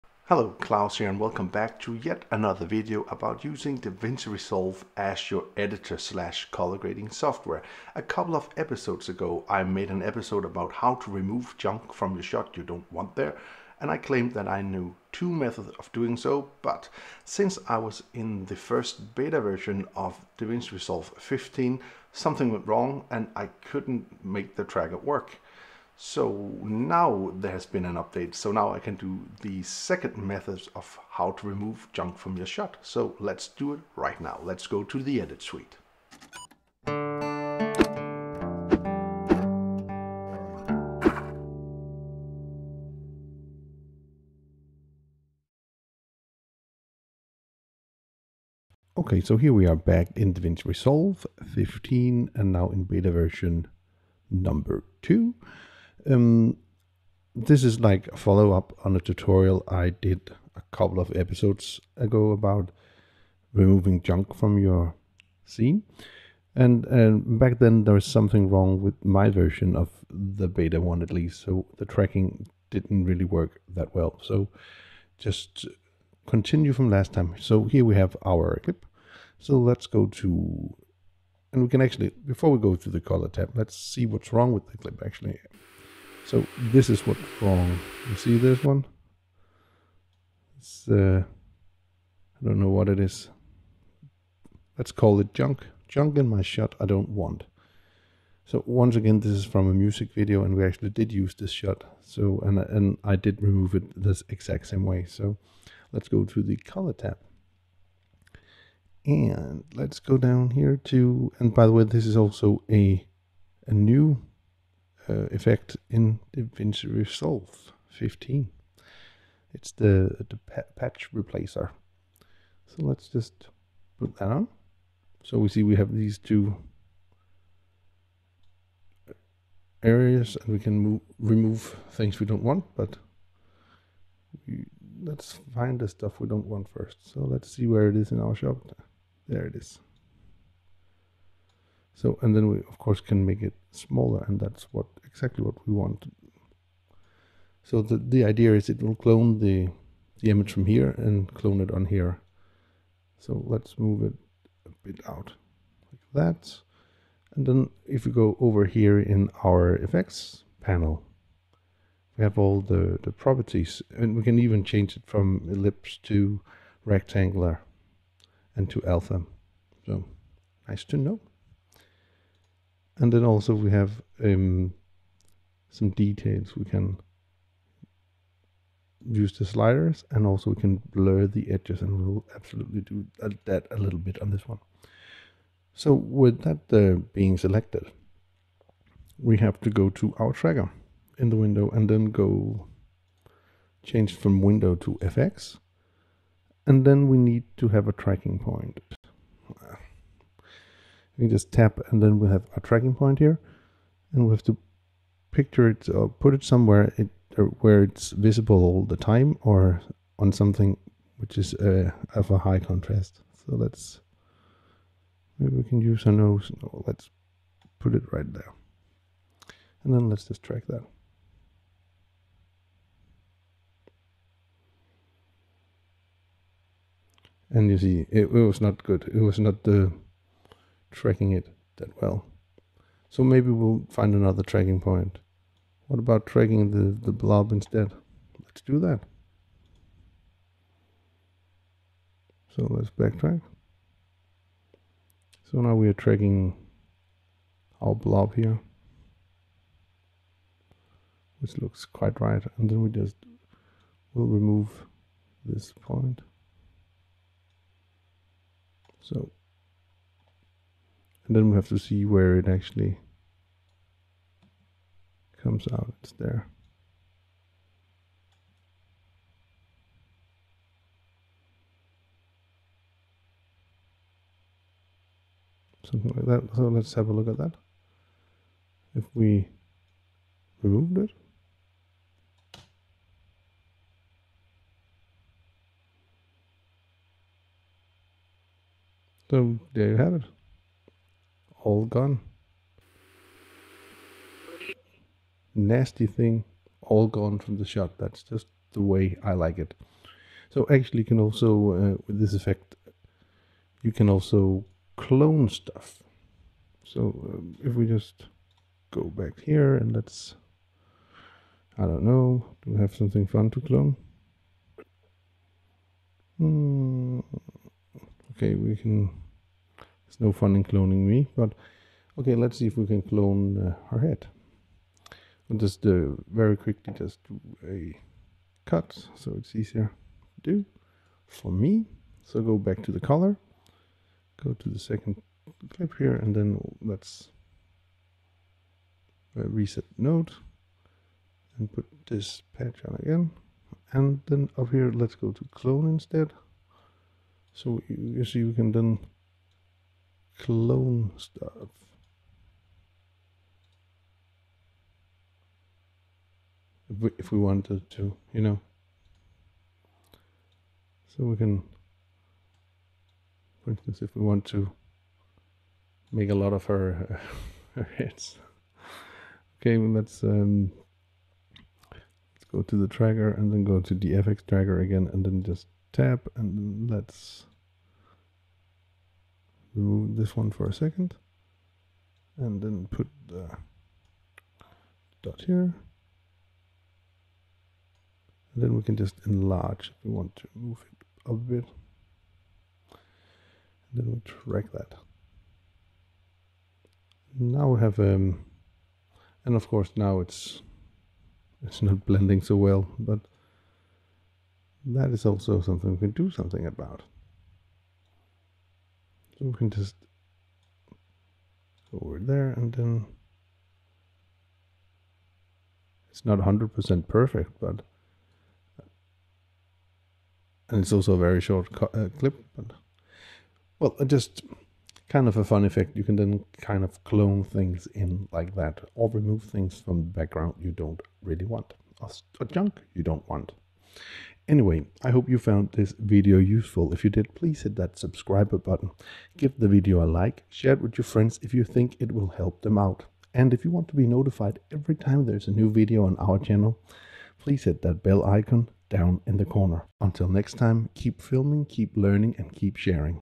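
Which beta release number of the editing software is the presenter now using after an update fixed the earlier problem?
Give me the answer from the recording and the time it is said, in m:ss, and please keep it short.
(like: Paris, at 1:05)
beta version 2, at 0:52.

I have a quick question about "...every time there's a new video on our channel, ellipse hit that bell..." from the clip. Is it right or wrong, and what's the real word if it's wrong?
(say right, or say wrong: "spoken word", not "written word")
wrong: "please", not "ellipse".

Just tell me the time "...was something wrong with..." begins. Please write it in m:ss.
1:07.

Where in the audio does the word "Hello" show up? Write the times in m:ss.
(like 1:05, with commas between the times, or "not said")
0:00.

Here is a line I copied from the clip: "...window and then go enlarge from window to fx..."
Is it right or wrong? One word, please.
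wrong.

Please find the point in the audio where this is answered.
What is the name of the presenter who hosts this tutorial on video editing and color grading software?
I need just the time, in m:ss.
0:00.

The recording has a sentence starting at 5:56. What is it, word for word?
If we, if we wanted to, you know.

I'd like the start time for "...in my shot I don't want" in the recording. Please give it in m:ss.
1:36.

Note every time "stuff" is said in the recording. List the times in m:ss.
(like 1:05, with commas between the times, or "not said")
2:15, 5:05, 5:51.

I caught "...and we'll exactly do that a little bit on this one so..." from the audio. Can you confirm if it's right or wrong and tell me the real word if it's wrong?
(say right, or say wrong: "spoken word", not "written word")
wrong: "absolutely", not "exactly".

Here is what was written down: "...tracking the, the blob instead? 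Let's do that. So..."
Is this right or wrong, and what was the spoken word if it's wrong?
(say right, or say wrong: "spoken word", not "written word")
right.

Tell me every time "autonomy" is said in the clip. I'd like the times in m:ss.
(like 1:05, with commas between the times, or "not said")
not said.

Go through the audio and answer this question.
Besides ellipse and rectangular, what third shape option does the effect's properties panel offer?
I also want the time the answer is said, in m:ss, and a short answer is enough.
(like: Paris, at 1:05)
Alpha, at 2:48.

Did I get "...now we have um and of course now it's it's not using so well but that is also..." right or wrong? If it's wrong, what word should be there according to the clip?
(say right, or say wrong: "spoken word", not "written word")
wrong: "blending", not "using".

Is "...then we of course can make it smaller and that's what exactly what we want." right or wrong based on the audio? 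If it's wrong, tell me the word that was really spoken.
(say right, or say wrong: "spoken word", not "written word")
right.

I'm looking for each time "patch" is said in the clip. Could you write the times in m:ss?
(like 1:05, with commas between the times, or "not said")
2:00, 5:42.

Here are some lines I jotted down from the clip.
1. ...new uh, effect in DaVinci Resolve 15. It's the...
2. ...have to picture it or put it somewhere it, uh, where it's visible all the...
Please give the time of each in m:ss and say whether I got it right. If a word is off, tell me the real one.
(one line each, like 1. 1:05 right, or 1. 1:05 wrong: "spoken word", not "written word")
1. 1:53 right
2. 3:24 right.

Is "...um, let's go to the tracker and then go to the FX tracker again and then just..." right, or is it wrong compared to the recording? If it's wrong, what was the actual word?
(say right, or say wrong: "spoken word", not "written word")
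right.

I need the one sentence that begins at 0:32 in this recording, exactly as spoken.
So let's do it right now.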